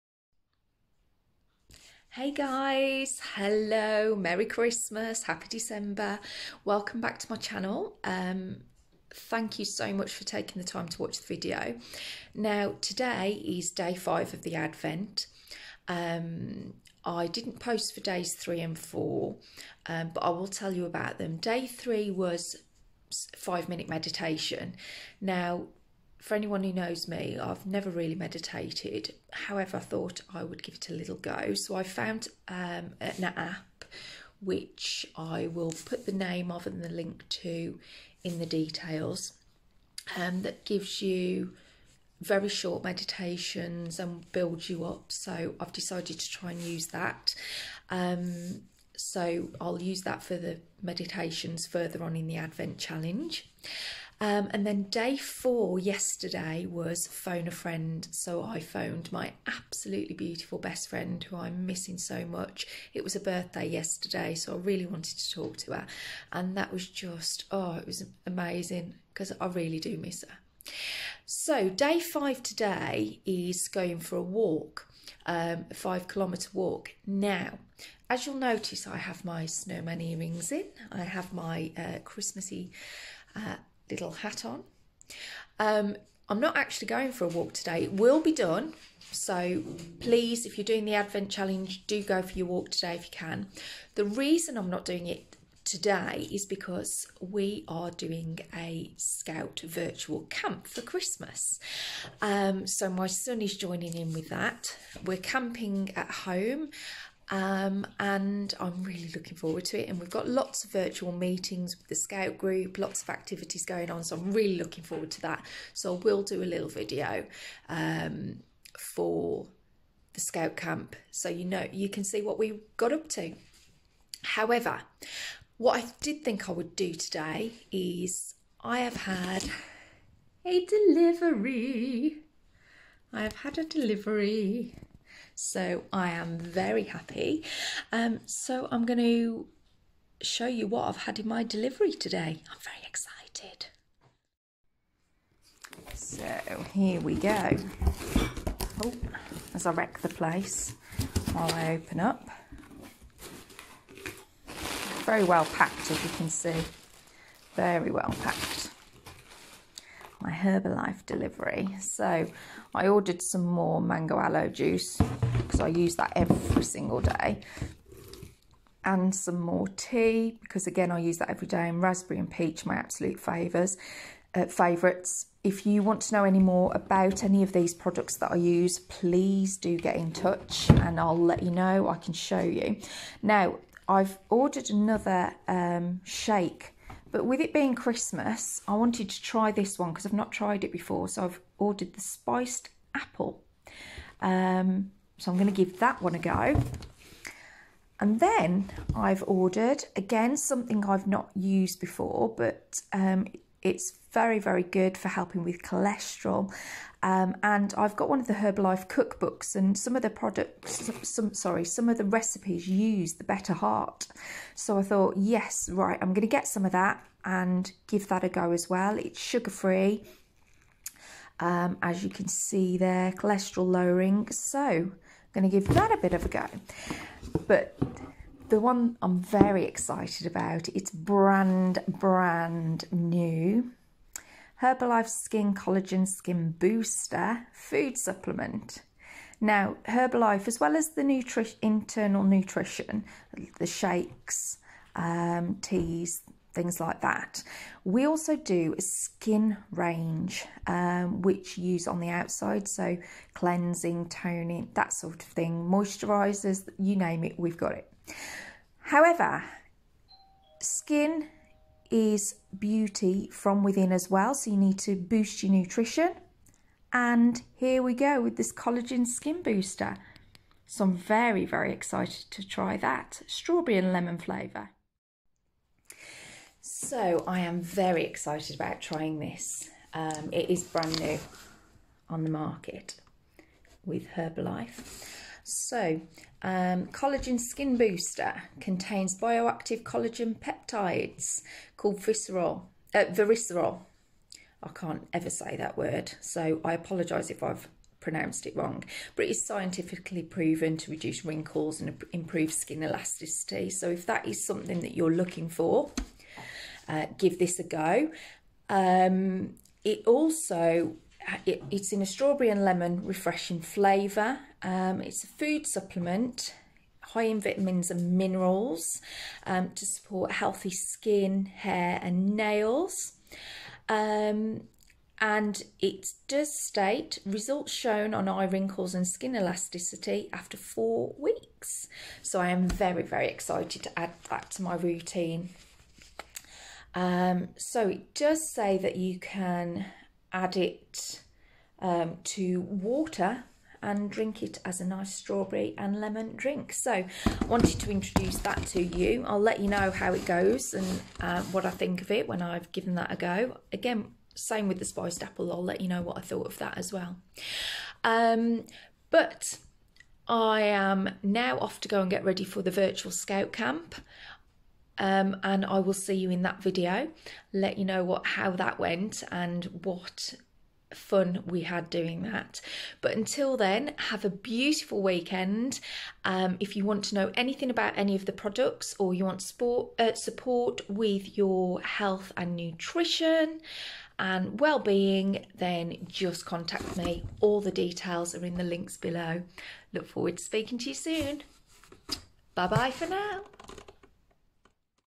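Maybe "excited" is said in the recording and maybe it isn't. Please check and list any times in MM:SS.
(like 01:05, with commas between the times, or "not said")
02:22, 03:49, 04:31, 04:38, 05:33.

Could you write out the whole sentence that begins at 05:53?
Again, same with the spiced apple.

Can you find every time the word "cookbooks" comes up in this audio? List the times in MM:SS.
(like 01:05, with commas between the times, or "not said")
03:28.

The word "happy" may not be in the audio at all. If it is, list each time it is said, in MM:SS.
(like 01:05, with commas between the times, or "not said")
00:05, 02:16.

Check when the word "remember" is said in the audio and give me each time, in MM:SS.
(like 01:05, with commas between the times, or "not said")
not said.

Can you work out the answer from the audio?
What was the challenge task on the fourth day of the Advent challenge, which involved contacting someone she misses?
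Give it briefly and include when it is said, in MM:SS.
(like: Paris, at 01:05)
Phone a friend, at 00:57.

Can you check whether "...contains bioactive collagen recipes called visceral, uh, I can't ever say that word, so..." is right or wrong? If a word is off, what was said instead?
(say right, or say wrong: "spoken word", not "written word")
wrong: "peptides", not "recipes".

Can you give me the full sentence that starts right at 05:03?
So if that is something that you're looking for, uh, give this a go.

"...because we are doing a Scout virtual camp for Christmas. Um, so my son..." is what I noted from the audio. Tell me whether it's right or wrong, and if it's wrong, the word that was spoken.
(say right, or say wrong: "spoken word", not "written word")
right.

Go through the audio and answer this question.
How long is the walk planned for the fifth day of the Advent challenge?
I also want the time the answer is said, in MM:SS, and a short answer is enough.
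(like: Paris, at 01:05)
5 kilometres, at 01:15.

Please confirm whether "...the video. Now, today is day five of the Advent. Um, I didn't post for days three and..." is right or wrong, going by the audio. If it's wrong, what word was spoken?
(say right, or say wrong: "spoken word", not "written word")
right.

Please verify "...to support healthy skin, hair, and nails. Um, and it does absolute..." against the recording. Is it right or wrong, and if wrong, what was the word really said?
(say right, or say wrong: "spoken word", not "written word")
wrong: "state", not "absolute".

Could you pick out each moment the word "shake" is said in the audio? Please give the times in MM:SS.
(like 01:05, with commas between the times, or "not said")
03:06, 04:03.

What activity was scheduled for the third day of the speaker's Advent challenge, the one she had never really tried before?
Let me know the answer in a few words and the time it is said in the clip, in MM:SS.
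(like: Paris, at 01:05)
5 minute meditation, at 00:23.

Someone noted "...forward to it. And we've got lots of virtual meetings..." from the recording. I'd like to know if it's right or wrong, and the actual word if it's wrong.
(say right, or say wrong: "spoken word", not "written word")
right.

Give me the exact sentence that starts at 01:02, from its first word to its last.
It was a birthday yesterday, so I really wanted to talk to her.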